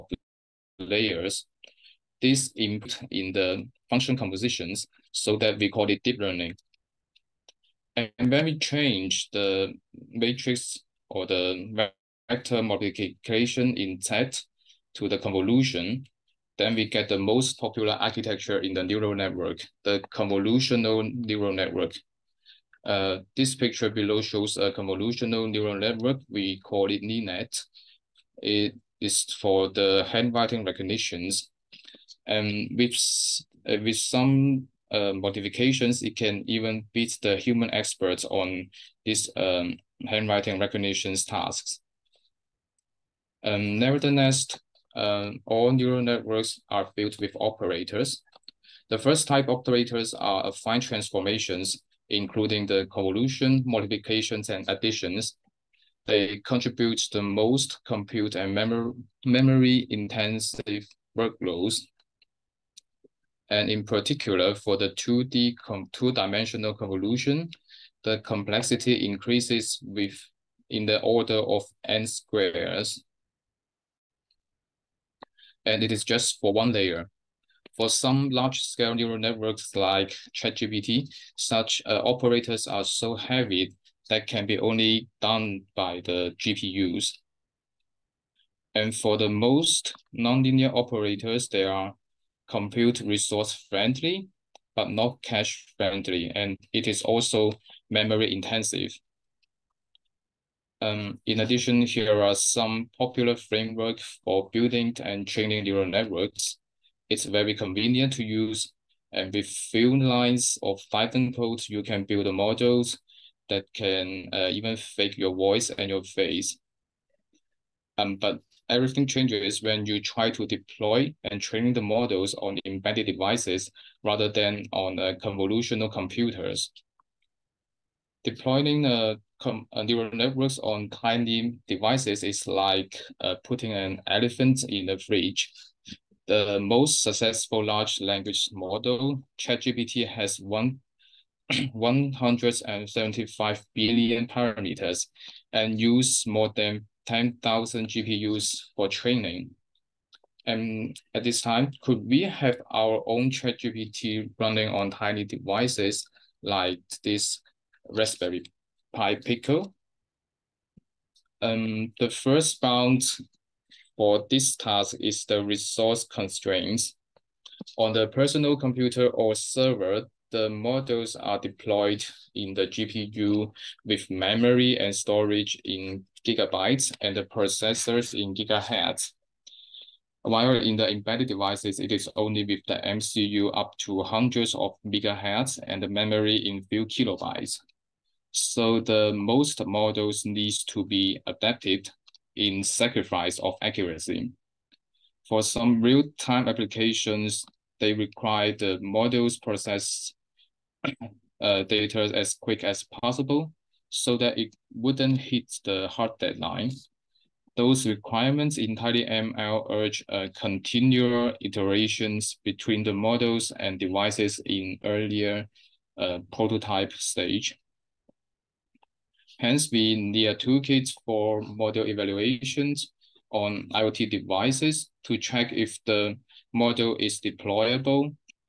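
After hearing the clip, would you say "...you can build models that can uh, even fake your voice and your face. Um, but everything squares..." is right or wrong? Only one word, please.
wrong.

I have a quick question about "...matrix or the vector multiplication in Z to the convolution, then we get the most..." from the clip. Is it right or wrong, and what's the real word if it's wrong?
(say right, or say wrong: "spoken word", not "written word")
right.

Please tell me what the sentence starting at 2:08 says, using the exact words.
Deploying a uh, uh, neural networks on tiny devices is like uh, putting an elephant in a fridge.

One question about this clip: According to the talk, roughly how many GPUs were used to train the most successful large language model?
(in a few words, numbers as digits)
more than 10,000.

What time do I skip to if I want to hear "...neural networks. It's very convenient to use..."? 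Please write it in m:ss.
1:45.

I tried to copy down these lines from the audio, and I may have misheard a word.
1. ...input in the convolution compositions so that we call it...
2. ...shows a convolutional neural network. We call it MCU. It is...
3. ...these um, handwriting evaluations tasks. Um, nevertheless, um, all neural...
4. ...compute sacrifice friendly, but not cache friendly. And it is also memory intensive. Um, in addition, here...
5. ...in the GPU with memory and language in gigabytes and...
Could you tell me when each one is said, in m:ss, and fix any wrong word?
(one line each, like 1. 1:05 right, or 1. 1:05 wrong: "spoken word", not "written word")
1. 0:02 wrong: "function", not "convolution"
2. 0:24 wrong: "LeNet", not "MCU"
3. 0:39 wrong: "recognitions", not "evaluations"
4. 1:32 wrong: "resource", not "sacrifice"
5. 2:52 wrong: "storage", not "language".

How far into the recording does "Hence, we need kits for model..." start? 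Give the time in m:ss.
3:39.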